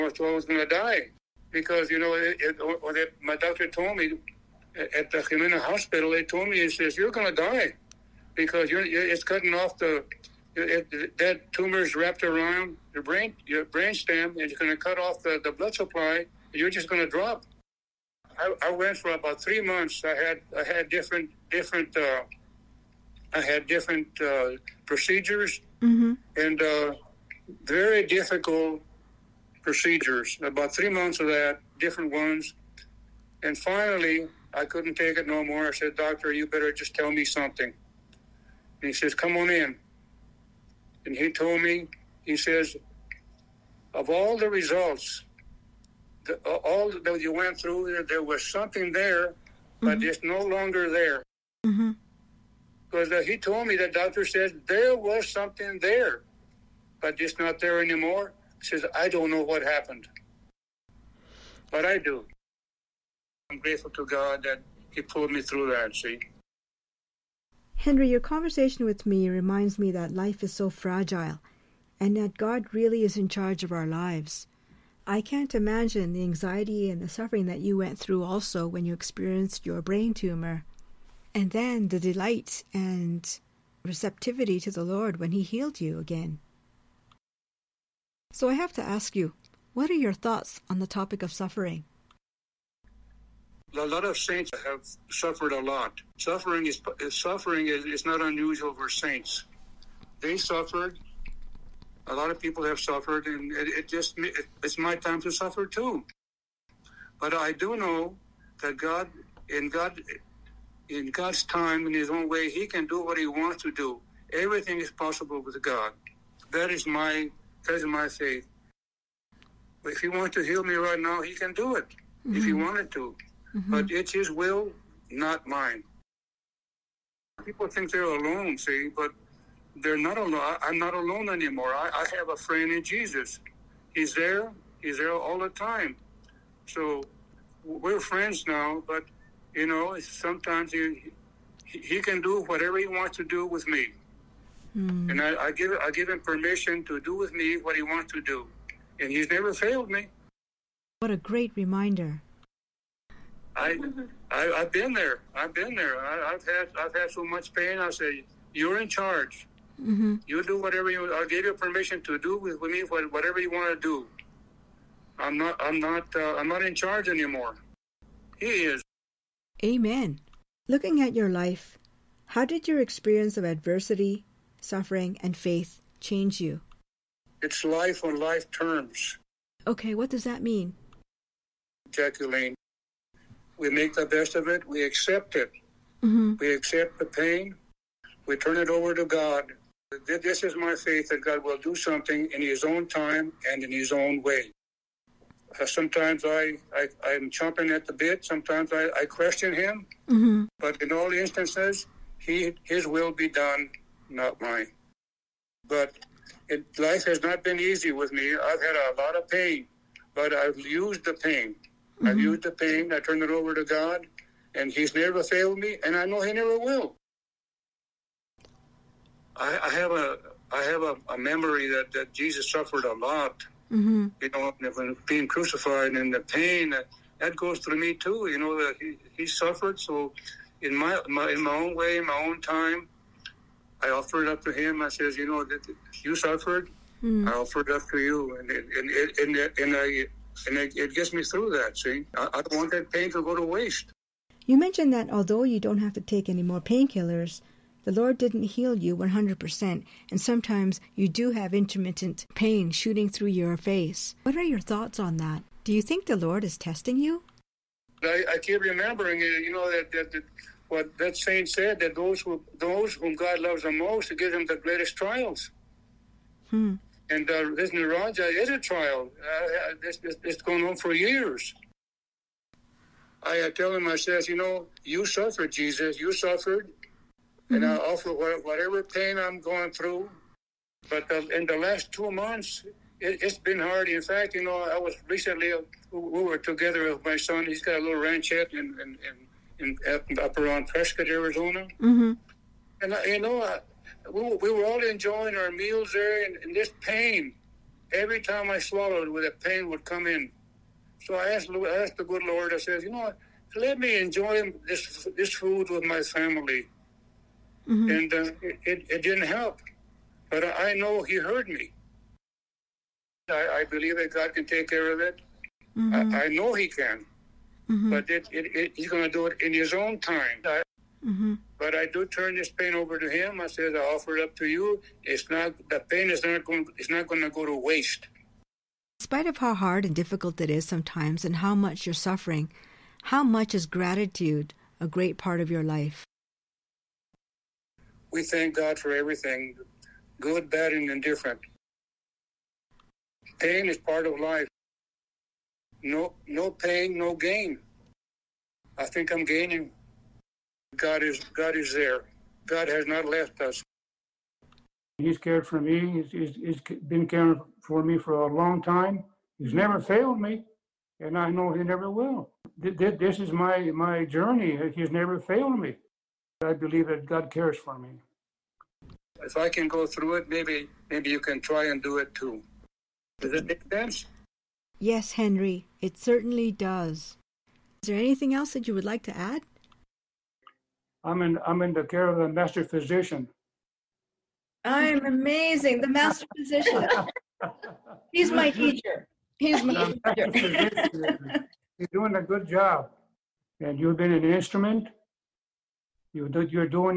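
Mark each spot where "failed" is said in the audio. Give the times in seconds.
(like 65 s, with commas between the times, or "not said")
149 s, 215 s, 359 s, 365 s.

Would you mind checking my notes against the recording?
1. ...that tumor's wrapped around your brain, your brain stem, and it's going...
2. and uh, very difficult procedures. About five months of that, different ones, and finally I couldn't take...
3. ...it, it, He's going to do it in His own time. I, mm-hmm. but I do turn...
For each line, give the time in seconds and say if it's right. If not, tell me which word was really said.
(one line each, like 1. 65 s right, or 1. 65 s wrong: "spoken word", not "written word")
1. 11 s right
2. 26 s wrong: "three", not "five"
3. 318 s right.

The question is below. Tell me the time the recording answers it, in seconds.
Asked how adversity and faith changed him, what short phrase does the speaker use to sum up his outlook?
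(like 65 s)
177 s.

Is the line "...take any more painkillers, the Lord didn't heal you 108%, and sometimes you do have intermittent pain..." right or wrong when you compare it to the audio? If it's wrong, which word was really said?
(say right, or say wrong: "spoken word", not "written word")
wrong: "100", not "108".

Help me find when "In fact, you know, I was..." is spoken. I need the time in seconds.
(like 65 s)
283 s.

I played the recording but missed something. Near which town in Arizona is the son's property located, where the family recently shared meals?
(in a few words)
Prescott.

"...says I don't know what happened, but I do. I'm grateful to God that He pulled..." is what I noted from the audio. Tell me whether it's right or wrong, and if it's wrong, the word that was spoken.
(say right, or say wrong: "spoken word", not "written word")
right.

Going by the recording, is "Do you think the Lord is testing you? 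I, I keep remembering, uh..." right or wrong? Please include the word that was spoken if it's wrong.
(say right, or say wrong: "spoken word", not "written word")
right.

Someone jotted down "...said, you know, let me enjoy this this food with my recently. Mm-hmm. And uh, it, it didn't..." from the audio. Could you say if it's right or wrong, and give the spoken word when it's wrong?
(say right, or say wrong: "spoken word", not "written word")
wrong: "family", not "recently".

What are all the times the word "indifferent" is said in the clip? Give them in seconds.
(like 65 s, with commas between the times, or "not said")
340 s.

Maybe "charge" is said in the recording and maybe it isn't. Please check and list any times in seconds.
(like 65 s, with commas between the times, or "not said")
73 s, 158 s, 166 s.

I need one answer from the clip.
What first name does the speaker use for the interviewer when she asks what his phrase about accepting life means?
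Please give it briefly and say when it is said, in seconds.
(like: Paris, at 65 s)
Jacqueline, at 181 s.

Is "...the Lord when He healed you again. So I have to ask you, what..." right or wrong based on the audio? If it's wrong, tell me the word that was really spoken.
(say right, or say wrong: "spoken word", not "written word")
right.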